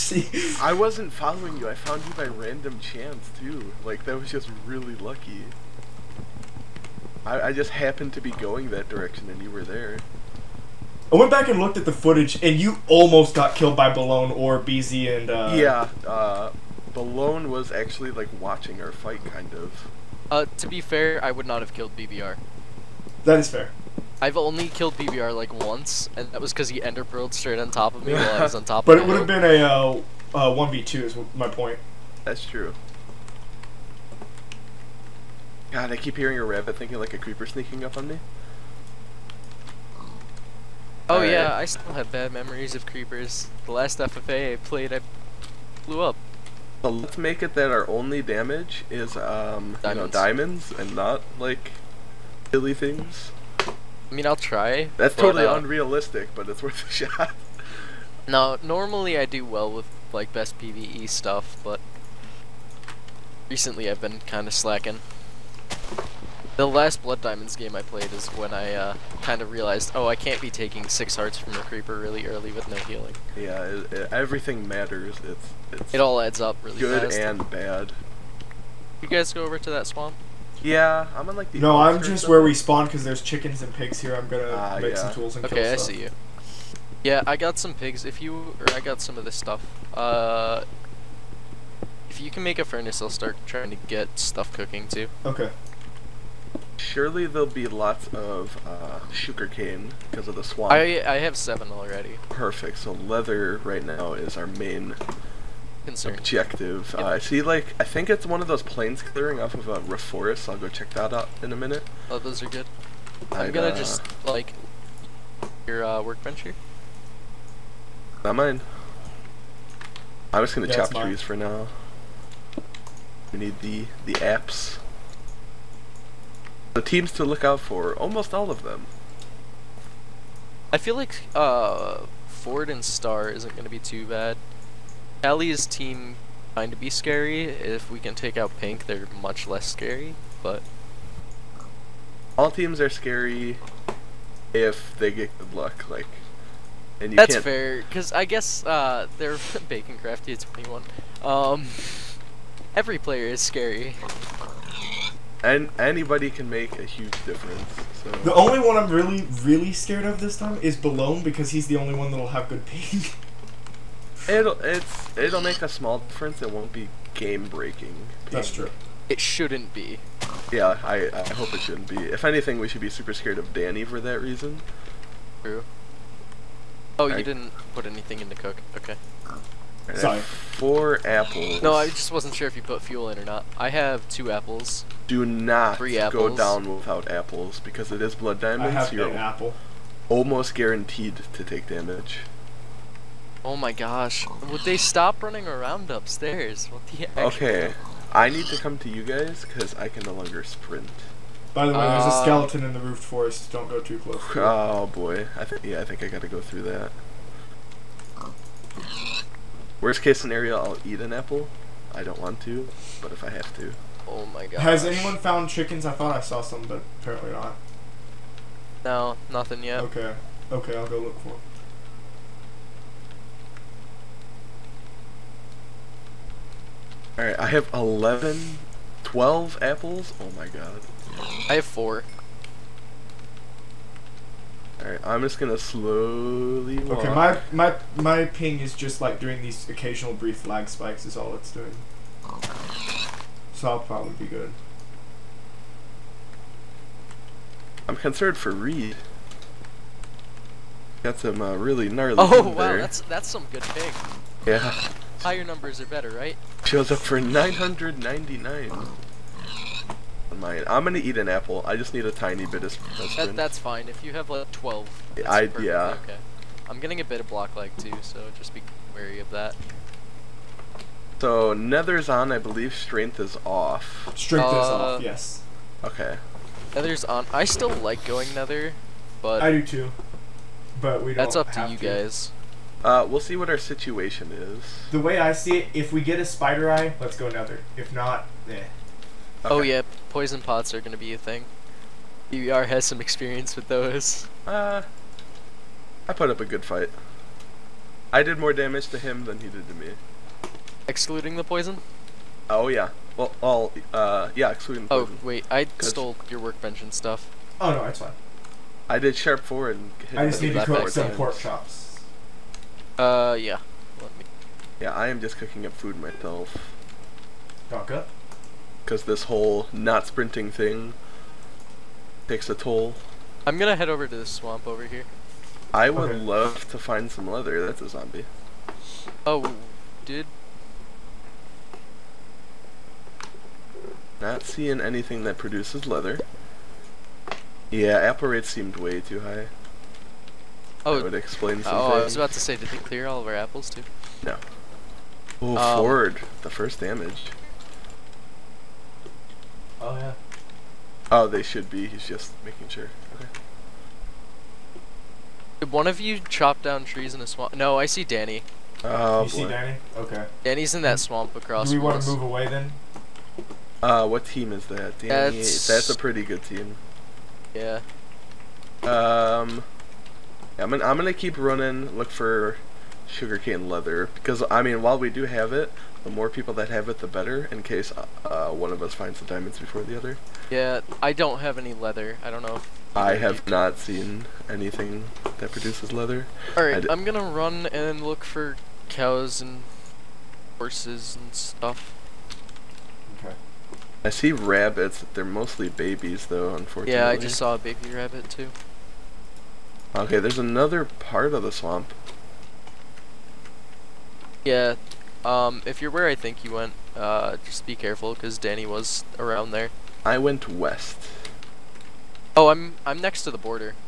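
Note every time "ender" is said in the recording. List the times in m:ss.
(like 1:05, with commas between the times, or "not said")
0:26.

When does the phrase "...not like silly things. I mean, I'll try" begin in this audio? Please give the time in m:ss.
0:50.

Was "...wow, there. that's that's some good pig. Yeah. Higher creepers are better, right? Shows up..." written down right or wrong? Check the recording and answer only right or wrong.
wrong.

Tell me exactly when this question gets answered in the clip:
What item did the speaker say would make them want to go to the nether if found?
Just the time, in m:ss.
4:46.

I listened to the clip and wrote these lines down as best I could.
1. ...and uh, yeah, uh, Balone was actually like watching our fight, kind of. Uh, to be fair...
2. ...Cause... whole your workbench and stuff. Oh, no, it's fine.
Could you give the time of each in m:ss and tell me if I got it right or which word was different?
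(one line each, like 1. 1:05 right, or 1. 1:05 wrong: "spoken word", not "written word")
1. 0:15 right
2. 5:05 wrong: "stole", not "whole".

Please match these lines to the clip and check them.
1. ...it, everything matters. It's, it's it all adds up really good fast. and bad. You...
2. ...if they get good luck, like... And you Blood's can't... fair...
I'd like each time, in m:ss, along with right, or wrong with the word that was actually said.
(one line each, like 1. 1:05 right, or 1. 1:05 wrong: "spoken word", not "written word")
1. 1:13 right
2. 2:24 wrong: "That", not "Blood".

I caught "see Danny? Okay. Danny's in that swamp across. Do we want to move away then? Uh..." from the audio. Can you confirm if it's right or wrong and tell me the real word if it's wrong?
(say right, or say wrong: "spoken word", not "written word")
right.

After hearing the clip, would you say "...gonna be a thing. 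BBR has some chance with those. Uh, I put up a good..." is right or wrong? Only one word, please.
wrong.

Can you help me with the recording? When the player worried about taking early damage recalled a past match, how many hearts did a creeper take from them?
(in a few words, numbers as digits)
6.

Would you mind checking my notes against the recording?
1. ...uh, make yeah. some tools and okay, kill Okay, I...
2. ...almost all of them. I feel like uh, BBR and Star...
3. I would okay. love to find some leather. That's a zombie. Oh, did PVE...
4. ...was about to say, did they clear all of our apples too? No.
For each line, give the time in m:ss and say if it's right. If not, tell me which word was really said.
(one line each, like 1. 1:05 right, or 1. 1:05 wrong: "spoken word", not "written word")
1. 1:24 right
2. 2:07 wrong: "Ford", not "BBR"
3. 5:25 wrong: "Not", not "PVE"
4. 5:42 right.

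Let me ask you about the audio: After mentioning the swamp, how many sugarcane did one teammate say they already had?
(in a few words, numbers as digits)
7.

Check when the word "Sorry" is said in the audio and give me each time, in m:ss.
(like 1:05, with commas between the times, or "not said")
2:59.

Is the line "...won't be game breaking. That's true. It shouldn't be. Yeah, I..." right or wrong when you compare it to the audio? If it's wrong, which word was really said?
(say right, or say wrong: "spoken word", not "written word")
right.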